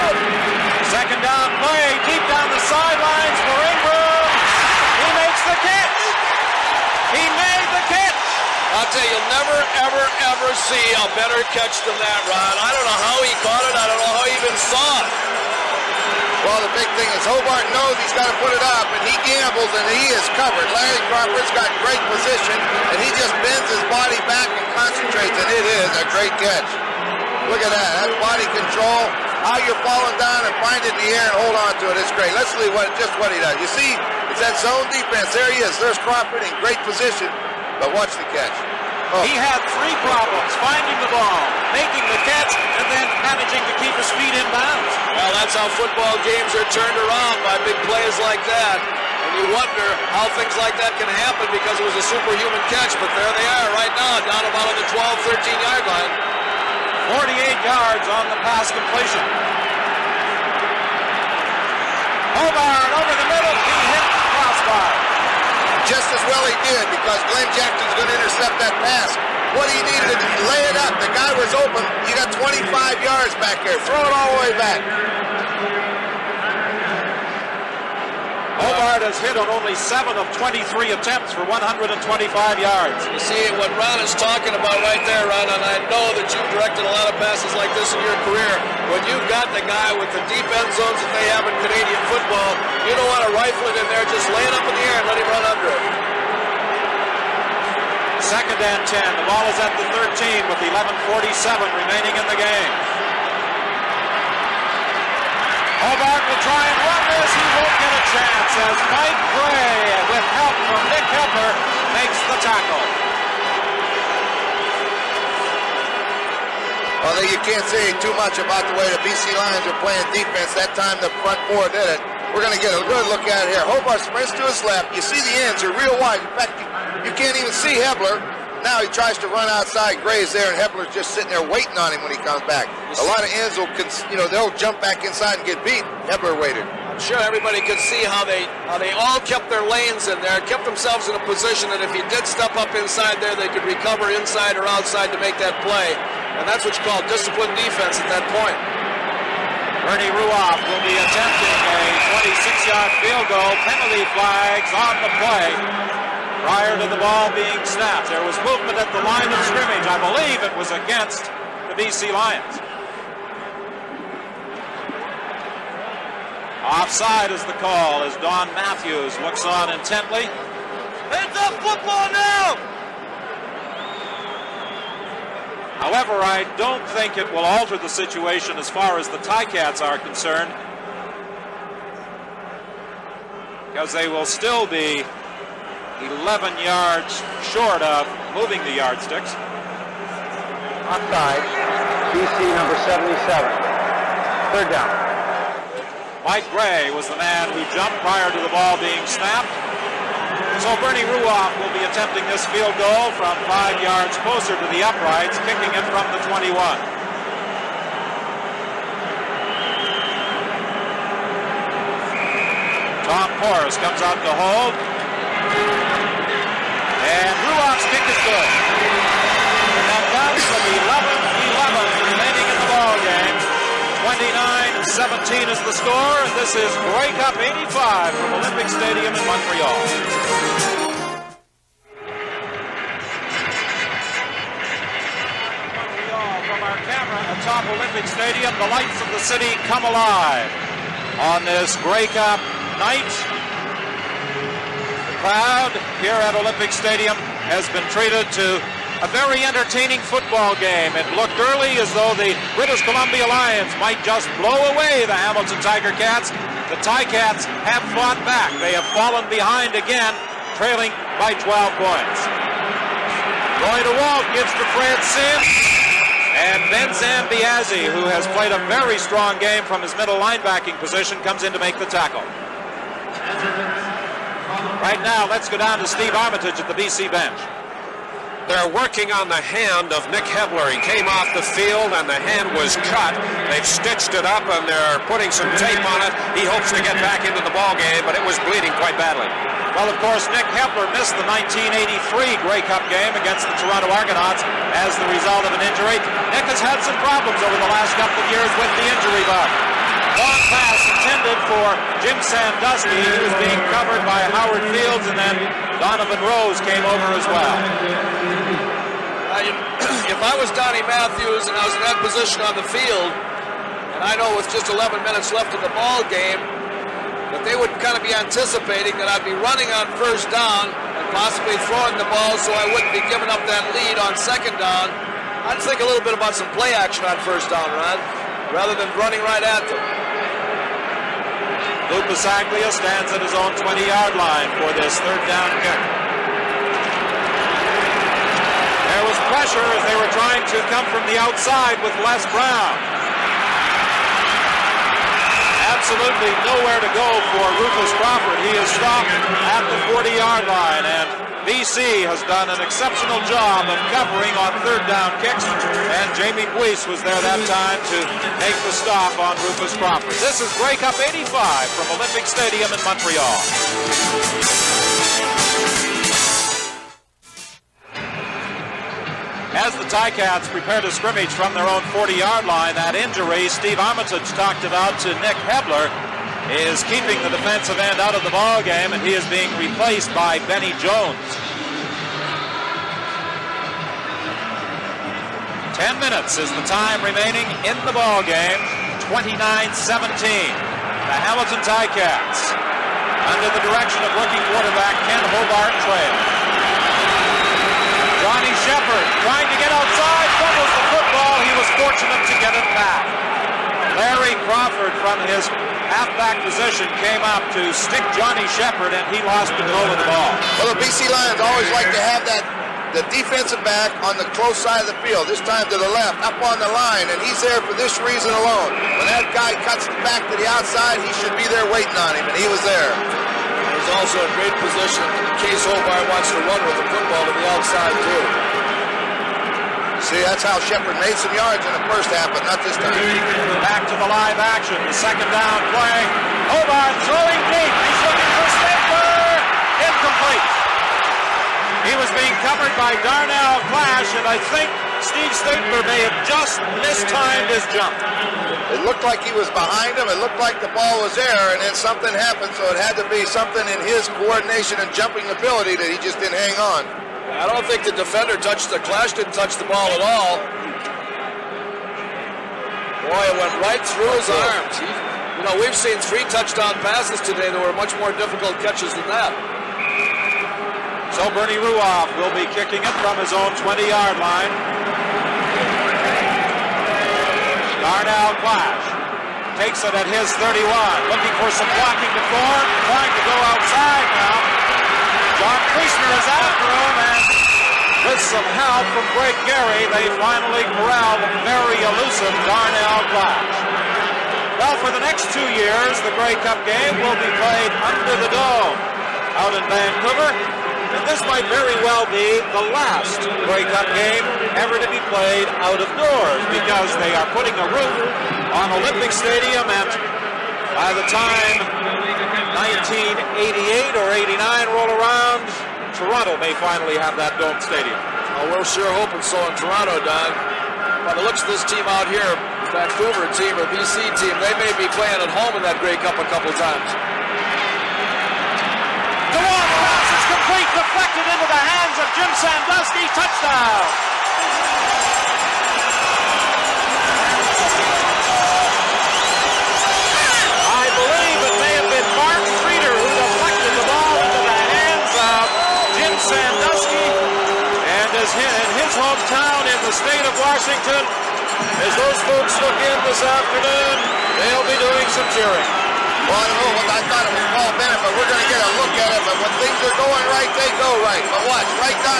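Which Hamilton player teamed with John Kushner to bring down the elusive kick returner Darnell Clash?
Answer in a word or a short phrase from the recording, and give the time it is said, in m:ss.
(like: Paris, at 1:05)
Greg Gary, at 8:09.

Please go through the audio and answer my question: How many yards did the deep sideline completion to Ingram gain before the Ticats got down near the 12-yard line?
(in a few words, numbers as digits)
48.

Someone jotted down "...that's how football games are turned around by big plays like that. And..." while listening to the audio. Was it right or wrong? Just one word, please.
right.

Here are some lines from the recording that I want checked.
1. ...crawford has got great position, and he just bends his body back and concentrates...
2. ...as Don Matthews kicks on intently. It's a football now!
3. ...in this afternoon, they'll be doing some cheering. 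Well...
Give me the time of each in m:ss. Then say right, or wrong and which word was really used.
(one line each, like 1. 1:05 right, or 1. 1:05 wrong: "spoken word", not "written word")
1. 0:21 right
2. 2:48 wrong: "looks", not "kicks"
3. 9:12 right.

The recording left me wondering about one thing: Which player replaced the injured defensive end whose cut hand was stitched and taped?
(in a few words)
Benny Jones.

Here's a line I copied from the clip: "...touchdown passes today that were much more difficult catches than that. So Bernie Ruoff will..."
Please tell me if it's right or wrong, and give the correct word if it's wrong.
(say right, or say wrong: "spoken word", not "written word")
right.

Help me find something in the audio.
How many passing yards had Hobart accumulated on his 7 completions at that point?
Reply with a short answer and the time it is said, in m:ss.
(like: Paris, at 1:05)
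125, at 1:21.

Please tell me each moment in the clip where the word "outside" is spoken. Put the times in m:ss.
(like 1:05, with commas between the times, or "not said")
2:09, 2:24, 5:41, 6:39, 7:00, 7:07, 8:03.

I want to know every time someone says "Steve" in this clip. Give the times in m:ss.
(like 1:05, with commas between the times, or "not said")
4:35, 6:13, 7:25.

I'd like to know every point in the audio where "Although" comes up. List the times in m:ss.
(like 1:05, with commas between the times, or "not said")
1:57.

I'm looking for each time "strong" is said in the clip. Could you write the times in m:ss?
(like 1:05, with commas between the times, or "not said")
4:29.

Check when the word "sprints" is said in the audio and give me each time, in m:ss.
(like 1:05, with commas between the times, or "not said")
2:04.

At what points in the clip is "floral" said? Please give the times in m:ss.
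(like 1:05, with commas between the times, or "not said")
not said.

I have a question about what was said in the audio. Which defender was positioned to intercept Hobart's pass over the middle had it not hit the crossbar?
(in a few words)
Glenn Jackson.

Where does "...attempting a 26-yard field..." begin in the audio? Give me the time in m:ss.
2:30.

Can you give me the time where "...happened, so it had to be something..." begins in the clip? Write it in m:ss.
7:32.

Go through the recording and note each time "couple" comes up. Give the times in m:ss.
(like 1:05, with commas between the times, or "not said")
4:57, 8:46.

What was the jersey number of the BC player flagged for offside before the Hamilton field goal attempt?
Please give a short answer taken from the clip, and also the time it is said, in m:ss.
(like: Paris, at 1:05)
77, at 3:12.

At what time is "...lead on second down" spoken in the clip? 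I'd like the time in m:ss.
5:23.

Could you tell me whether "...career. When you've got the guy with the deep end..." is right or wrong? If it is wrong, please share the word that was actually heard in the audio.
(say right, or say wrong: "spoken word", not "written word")
right.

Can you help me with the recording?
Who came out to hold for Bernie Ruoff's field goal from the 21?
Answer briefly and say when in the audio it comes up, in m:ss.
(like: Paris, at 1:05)
Tom Porras, at 3:33.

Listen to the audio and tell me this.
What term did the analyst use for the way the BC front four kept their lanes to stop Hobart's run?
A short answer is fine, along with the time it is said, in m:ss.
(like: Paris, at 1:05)
disciplined defense, at 2:27.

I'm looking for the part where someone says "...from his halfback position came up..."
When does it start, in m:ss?
6:44.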